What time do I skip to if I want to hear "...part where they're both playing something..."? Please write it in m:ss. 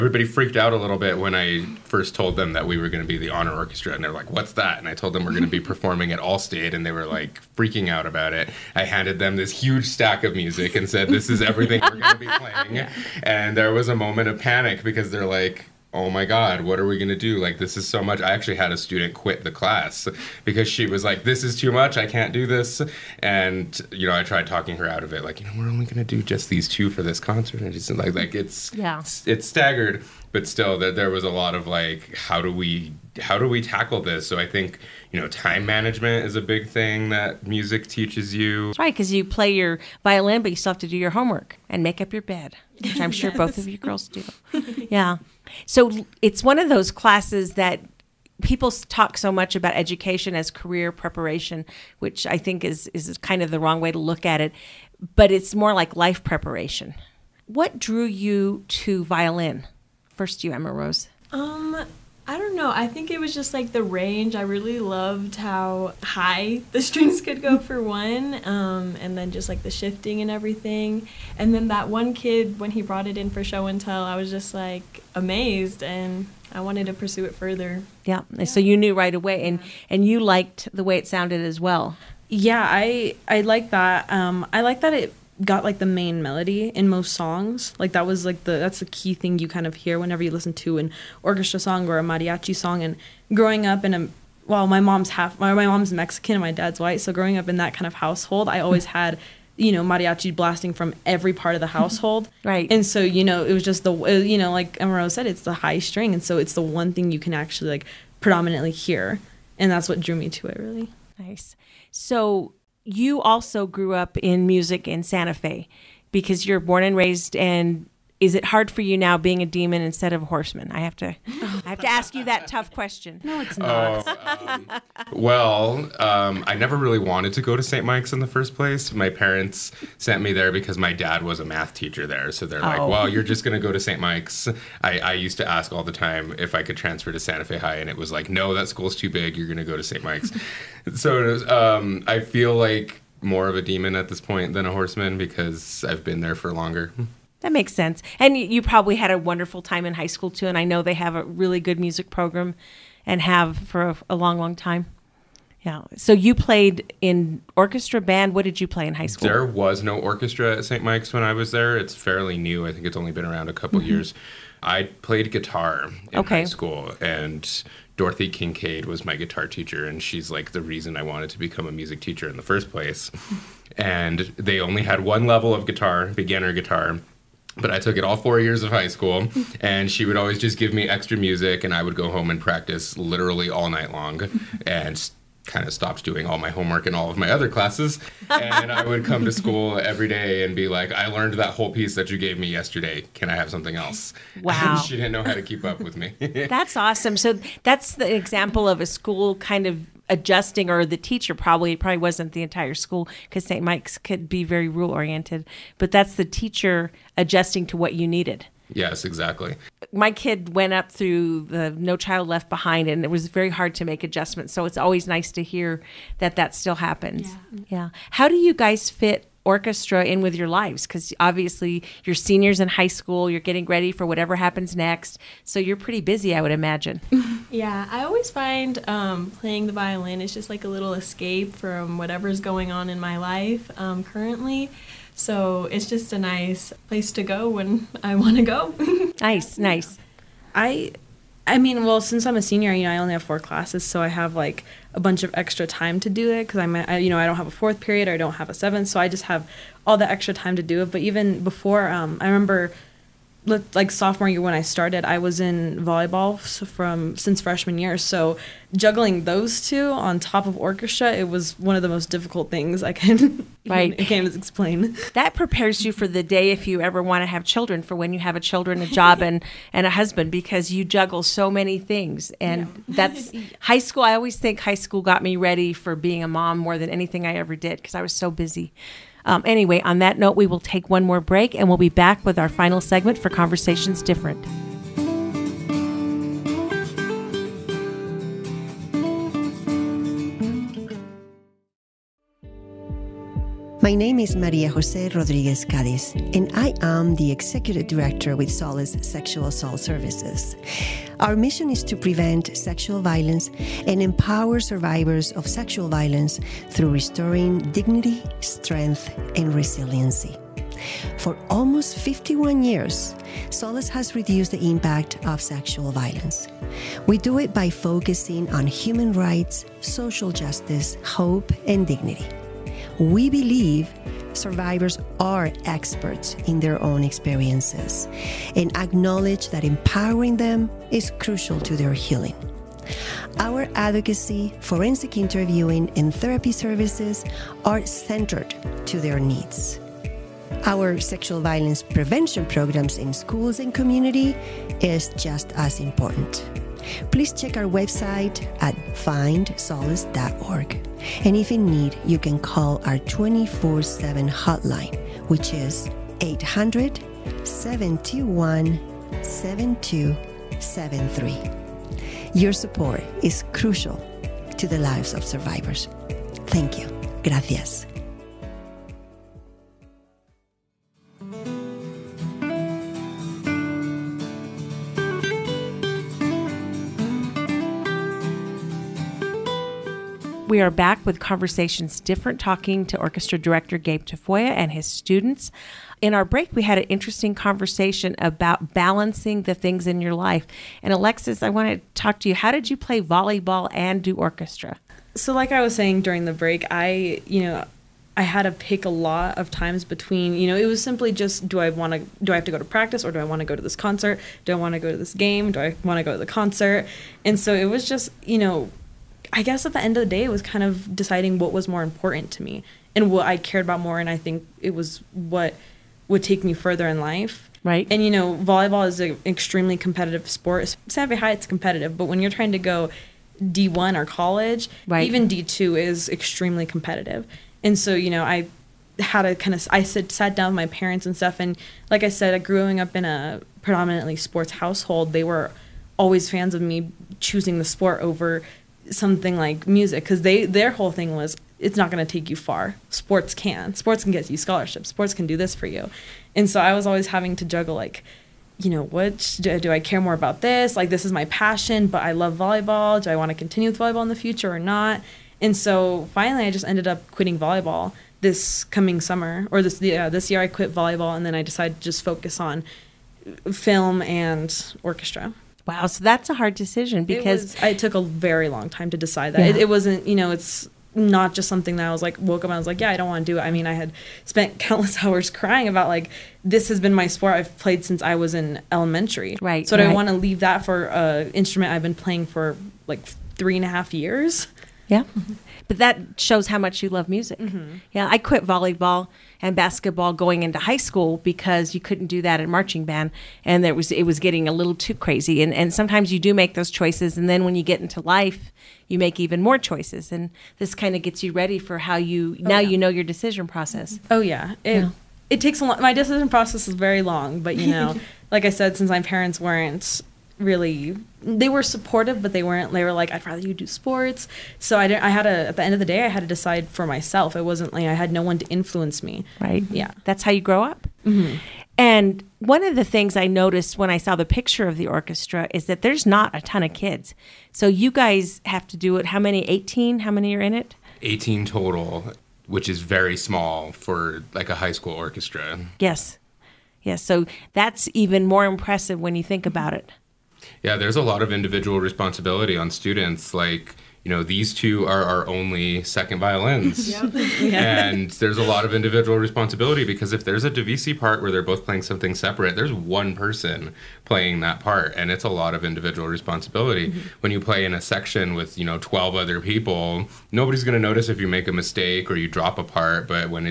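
9:10.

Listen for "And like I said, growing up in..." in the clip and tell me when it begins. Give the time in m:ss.
7:11.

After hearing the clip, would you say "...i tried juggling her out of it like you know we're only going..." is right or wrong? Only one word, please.
wrong.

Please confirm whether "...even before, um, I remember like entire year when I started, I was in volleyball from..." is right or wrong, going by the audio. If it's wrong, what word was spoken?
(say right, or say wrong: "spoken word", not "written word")
wrong: "sophomore", not "entire".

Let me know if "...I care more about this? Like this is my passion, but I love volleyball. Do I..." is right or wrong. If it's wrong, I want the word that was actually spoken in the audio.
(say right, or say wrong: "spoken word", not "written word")
right.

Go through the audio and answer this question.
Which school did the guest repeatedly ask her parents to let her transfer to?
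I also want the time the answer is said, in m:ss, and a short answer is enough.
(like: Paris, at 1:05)
Santa Fe High, at 2:17.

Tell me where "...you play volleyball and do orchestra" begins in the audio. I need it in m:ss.
6:32.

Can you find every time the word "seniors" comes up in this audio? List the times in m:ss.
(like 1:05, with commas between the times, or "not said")
3:42, 4:02.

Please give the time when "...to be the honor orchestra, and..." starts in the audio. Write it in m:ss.
0:03.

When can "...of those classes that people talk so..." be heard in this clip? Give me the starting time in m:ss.
0:46.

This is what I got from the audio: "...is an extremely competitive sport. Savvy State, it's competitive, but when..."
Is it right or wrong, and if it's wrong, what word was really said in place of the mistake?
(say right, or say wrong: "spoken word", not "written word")
wrong: "High", not "State".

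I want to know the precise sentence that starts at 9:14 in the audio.
And it's a lot of individual responsibility.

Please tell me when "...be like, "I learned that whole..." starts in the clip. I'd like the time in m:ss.
3:10.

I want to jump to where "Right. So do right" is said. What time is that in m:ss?
7:59.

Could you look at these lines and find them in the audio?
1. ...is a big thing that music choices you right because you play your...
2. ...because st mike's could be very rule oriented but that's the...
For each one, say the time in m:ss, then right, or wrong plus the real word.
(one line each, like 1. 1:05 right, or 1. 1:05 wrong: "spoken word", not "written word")
1. 0:36 wrong: "teaches", not "choices"
2. 3:23 right.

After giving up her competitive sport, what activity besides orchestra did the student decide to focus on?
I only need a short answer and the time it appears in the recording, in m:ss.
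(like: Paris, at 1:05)
film, at 7:43.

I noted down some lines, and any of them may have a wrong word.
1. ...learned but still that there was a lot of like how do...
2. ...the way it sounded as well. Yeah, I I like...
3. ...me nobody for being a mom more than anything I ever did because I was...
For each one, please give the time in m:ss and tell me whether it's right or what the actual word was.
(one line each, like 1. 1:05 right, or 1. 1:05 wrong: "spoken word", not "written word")
1. 0:29 wrong: "staggered", not "learned"
2. 1:20 right
3. 4:35 wrong: "ready", not "nobody".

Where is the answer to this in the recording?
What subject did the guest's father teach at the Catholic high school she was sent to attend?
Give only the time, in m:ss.
2:11.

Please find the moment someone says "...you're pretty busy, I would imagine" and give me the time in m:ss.
3:45.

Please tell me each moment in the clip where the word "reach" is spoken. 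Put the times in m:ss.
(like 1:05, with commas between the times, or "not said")
not said.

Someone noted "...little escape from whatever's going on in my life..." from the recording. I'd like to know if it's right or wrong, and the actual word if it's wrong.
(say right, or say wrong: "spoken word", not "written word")
right.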